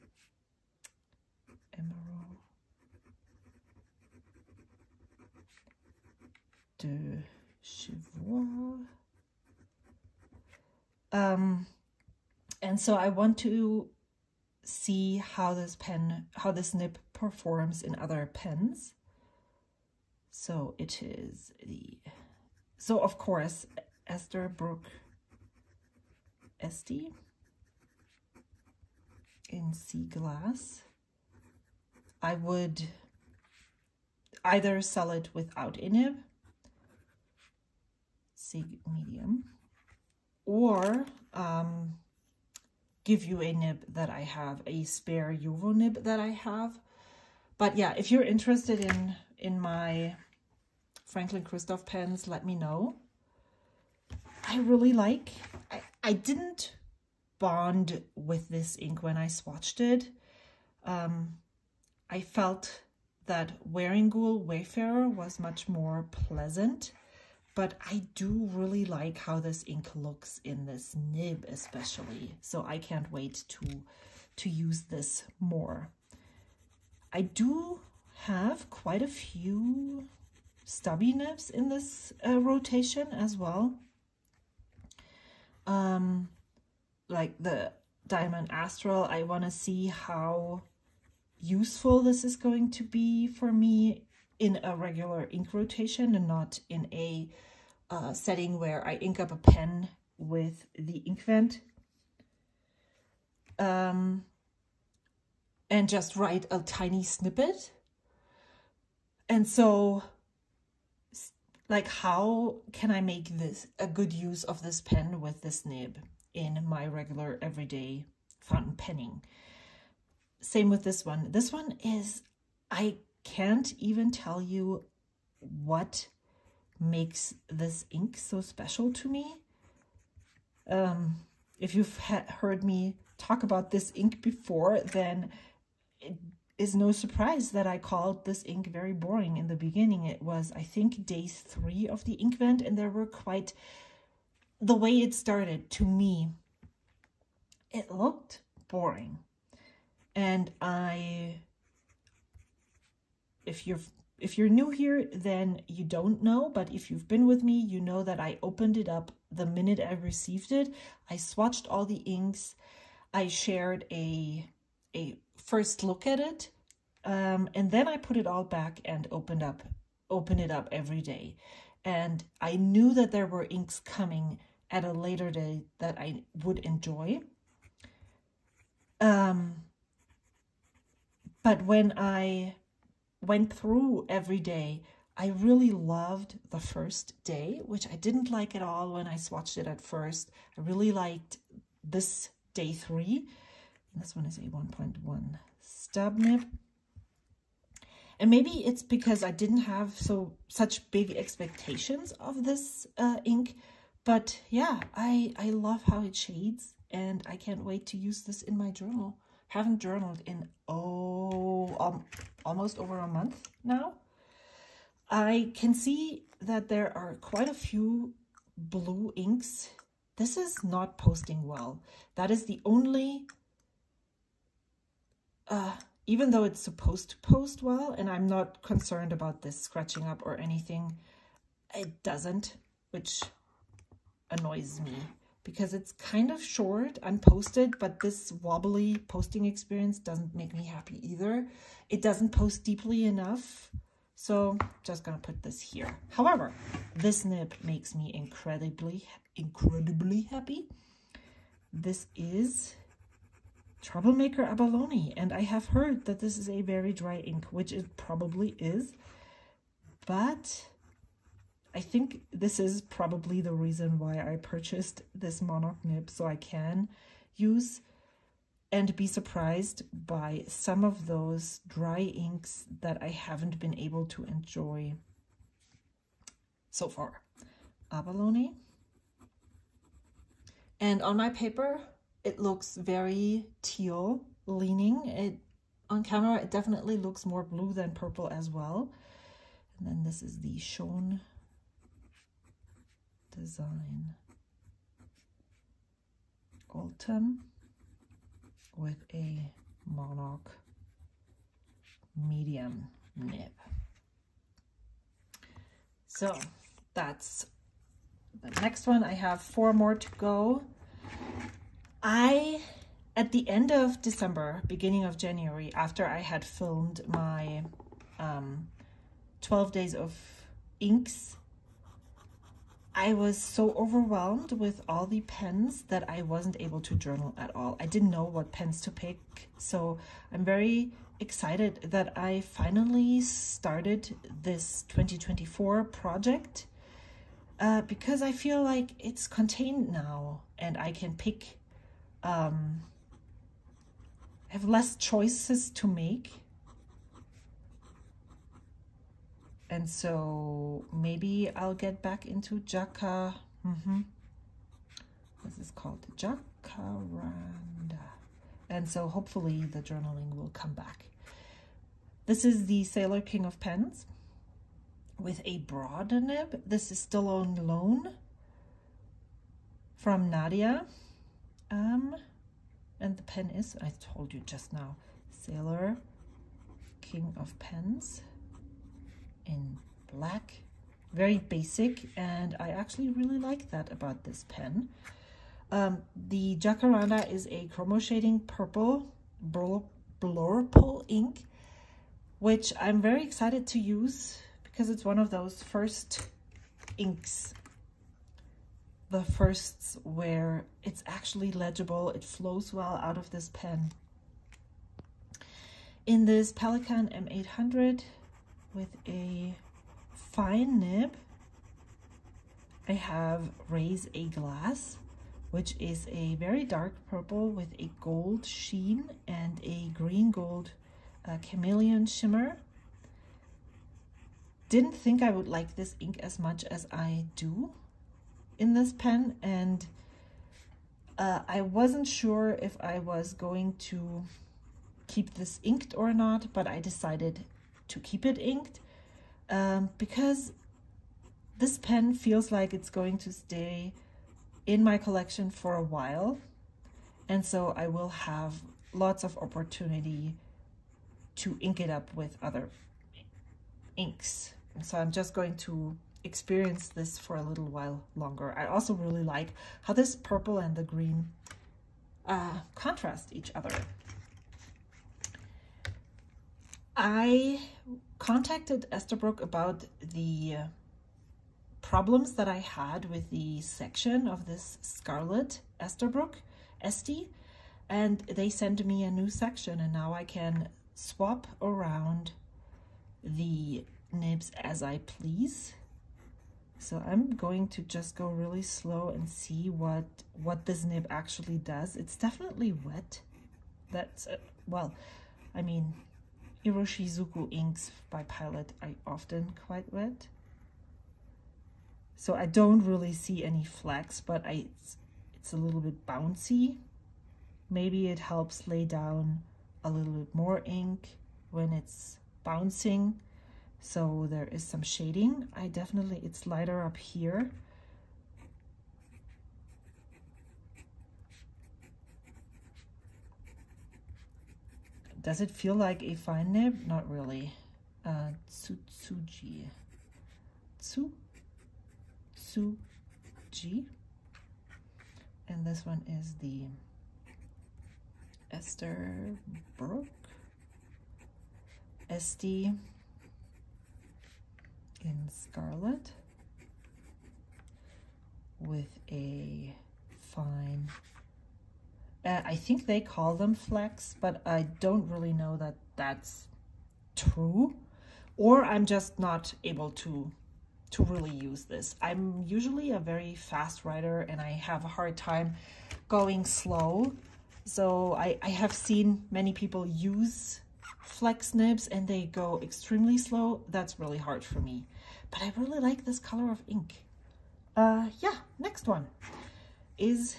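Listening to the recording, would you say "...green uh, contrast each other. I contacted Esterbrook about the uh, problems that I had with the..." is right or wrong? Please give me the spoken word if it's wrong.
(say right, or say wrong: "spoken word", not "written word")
right.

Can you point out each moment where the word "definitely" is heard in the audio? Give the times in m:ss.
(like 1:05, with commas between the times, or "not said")
4:46, 8:12, 8:35.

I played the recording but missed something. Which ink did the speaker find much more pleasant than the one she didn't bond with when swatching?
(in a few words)
Wearingeul Wayfarer.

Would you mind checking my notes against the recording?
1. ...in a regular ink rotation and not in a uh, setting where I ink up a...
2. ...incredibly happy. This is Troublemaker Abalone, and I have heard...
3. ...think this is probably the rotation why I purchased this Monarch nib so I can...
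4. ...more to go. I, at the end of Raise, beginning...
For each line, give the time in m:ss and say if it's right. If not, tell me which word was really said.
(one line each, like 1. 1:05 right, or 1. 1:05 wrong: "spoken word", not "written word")
1. 1:34 right
2. 4:09 right
3. 4:21 wrong: "reason", not "rotation"
4. 5:09 wrong: "December", not "Raise".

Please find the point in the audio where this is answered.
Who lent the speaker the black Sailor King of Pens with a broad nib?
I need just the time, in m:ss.
6:10.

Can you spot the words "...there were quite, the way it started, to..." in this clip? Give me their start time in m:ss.
2:22.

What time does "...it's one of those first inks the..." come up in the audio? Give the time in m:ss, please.
6:34.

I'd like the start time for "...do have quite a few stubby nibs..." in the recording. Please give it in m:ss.
1:17.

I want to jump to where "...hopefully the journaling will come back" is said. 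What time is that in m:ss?
5:59.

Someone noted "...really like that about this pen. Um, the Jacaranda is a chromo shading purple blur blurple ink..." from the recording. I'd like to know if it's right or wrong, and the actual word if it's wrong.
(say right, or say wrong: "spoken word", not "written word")
right.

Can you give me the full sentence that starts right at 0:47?
But yeah, if you're interested in, in my Franklin Christoph pens, let me know.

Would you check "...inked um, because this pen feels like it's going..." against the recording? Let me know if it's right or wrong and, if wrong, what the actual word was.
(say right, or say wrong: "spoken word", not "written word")
right.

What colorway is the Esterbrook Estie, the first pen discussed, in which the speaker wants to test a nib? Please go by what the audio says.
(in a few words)
Sea Glass.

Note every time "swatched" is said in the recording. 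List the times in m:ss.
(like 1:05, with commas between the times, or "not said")
0:59, 2:41, 3:09.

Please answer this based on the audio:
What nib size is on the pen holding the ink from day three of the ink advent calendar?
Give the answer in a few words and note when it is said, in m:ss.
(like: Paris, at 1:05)
1.1 stub, at 3:14.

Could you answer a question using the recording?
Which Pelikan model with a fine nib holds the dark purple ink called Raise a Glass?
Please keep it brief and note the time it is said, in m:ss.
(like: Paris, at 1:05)
M800, at 6:46.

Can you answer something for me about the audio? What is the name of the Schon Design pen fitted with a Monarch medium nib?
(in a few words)
Autumn.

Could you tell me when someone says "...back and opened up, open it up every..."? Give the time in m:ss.
2:48.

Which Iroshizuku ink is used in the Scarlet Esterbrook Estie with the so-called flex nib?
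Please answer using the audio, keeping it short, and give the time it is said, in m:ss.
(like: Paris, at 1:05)
Tsutsuji, at 8:48.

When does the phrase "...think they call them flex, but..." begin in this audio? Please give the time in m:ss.
9:12.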